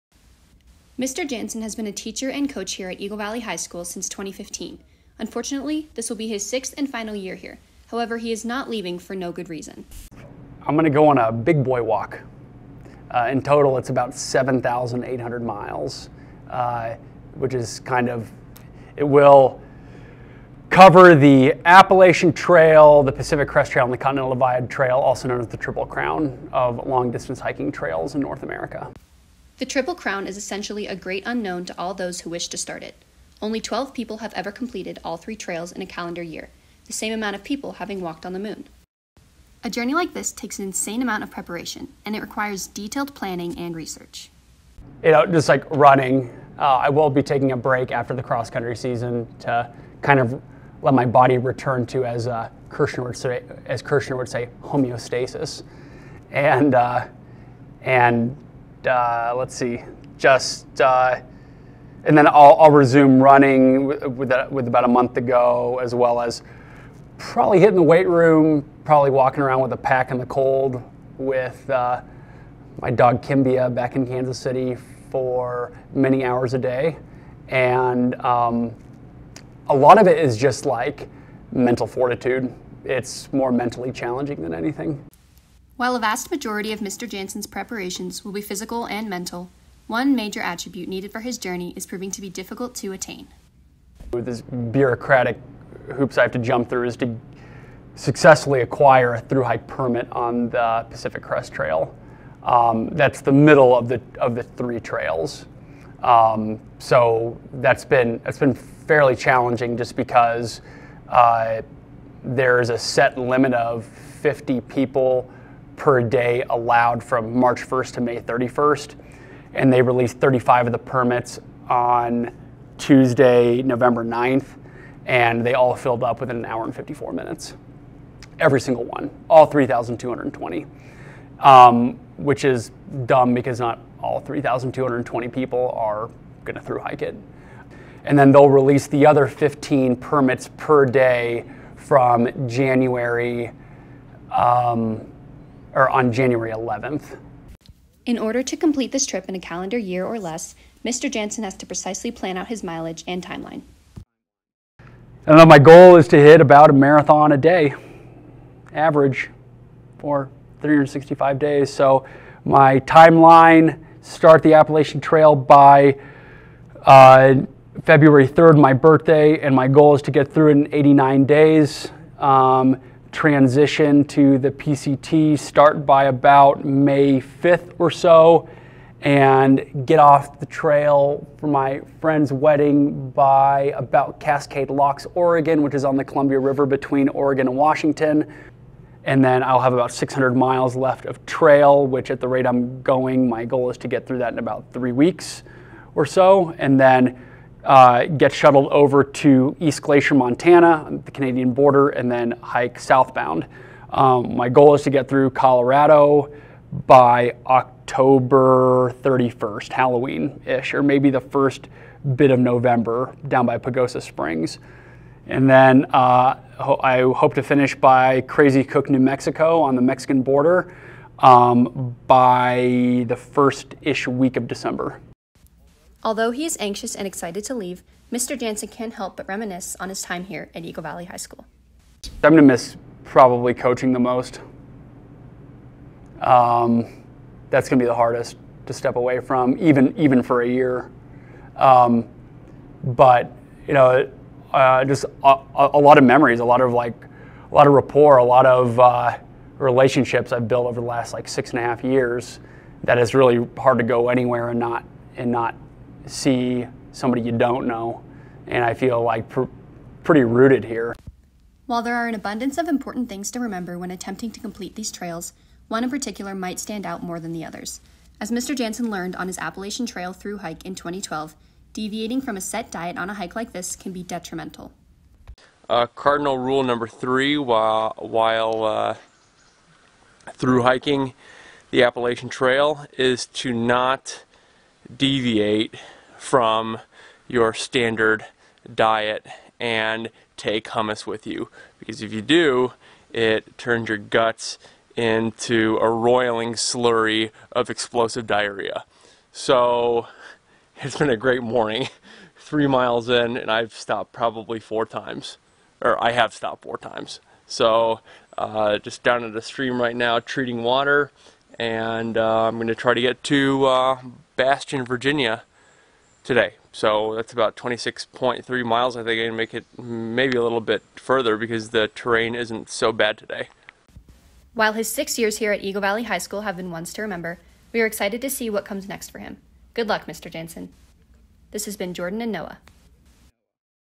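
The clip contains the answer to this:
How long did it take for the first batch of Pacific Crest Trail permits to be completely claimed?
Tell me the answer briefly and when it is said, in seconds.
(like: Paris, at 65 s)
1 hour and 54 minutes, at 126 s.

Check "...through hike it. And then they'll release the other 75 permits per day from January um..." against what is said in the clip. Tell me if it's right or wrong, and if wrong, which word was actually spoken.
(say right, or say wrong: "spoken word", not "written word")
wrong: "15", not "75".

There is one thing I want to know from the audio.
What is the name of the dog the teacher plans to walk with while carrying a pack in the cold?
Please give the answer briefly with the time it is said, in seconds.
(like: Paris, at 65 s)
Kimbia, at 73 s.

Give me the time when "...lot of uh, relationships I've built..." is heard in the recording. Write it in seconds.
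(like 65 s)
248 s.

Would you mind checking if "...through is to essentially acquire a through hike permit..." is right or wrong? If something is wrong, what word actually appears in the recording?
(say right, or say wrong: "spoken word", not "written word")
wrong: "successfully", not "essentially".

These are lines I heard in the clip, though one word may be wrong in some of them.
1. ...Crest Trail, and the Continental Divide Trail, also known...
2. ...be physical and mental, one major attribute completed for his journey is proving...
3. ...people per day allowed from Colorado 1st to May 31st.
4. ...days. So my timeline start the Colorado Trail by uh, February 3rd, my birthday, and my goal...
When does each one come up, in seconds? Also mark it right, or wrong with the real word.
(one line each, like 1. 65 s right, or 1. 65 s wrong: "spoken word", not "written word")
1. 23 s right
2. 88 s wrong: "needed", not "completed"
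3. 114 s wrong: "March", not "Colorado"
4. 161 s wrong: "Appalachian", not "Colorado".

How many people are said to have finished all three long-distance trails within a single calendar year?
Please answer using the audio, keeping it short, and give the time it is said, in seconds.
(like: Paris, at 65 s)
12, at 33 s.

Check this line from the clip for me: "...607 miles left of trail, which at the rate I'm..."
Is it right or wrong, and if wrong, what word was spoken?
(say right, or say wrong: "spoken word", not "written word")
wrong: "600", not "607".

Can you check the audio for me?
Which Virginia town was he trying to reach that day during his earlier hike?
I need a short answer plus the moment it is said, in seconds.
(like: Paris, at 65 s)
Bastian, at 314 s.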